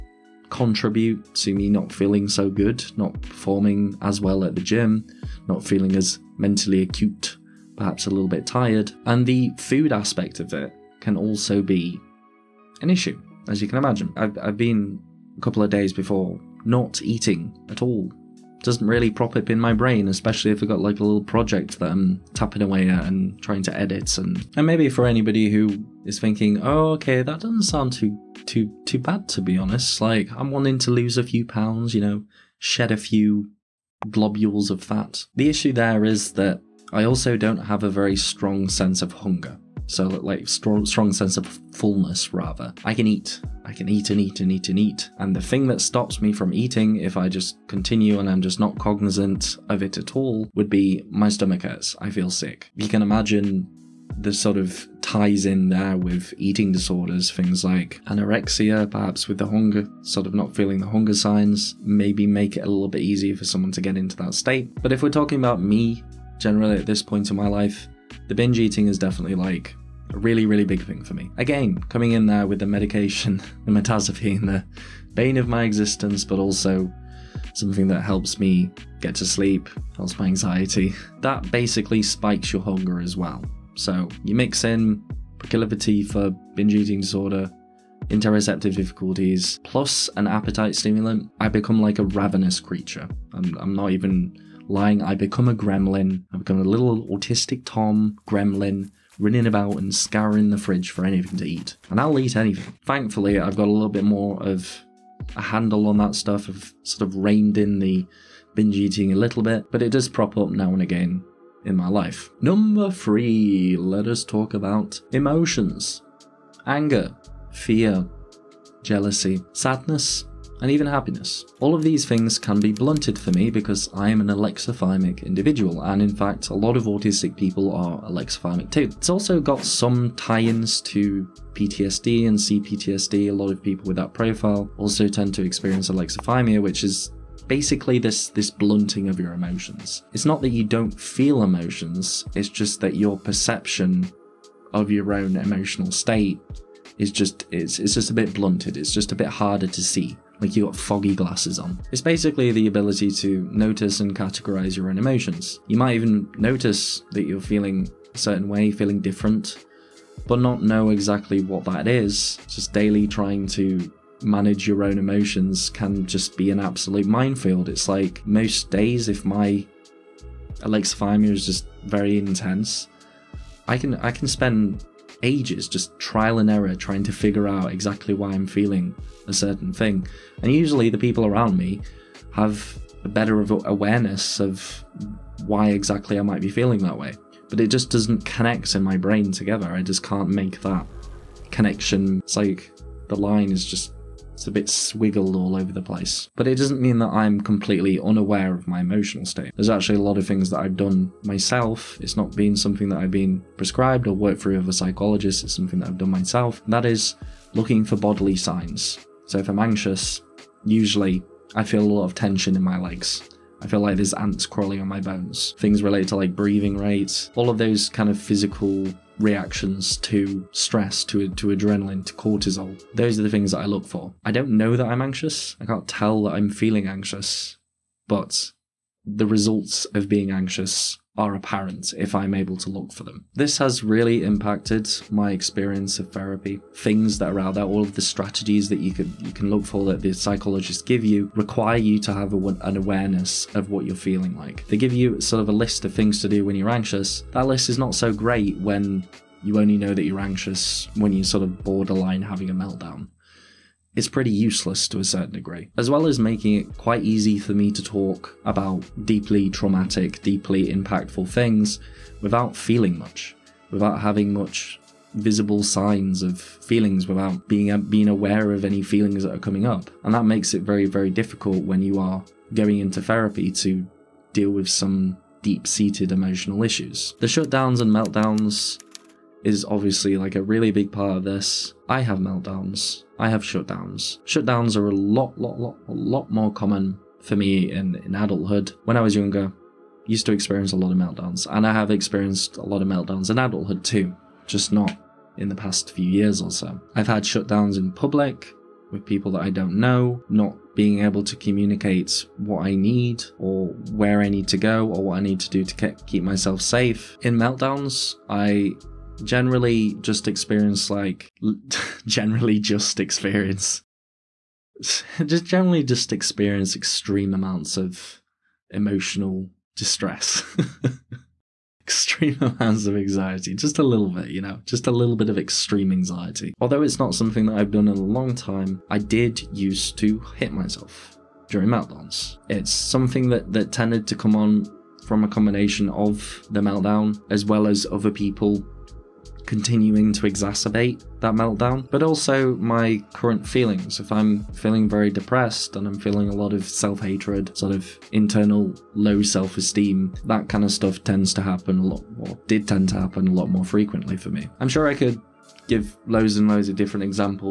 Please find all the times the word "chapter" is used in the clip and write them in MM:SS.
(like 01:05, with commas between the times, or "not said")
not said.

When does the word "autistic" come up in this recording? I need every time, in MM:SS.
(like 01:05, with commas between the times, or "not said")
01:37, 02:06.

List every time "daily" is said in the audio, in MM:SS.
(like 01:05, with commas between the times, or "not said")
02:42.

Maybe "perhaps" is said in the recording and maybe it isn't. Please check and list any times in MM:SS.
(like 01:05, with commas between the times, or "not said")
00:07, 00:58.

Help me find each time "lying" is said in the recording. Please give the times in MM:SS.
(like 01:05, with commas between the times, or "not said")
01:34.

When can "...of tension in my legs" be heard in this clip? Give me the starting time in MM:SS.
03:32.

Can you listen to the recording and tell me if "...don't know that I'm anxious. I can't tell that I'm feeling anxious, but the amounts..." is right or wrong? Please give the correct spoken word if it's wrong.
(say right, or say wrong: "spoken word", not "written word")
wrong: "results", not "amounts".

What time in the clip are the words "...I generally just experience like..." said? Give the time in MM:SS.
05:08.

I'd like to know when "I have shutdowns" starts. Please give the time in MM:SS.
04:43.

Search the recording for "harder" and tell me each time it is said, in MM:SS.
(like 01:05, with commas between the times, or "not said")
02:29.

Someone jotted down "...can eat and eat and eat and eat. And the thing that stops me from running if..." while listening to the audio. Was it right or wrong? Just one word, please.
wrong.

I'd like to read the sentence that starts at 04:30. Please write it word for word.
And that makes it very very difficult when you are going into therapy to deal with some deep-seated emotional issues.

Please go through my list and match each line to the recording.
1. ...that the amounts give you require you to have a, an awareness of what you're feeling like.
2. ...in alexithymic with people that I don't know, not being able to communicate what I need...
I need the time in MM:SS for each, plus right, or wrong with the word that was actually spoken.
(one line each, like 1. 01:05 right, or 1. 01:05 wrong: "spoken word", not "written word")
1. 03:59 wrong: "psychologists", not "amounts"
2. 04:57 wrong: "public", not "alexithymic".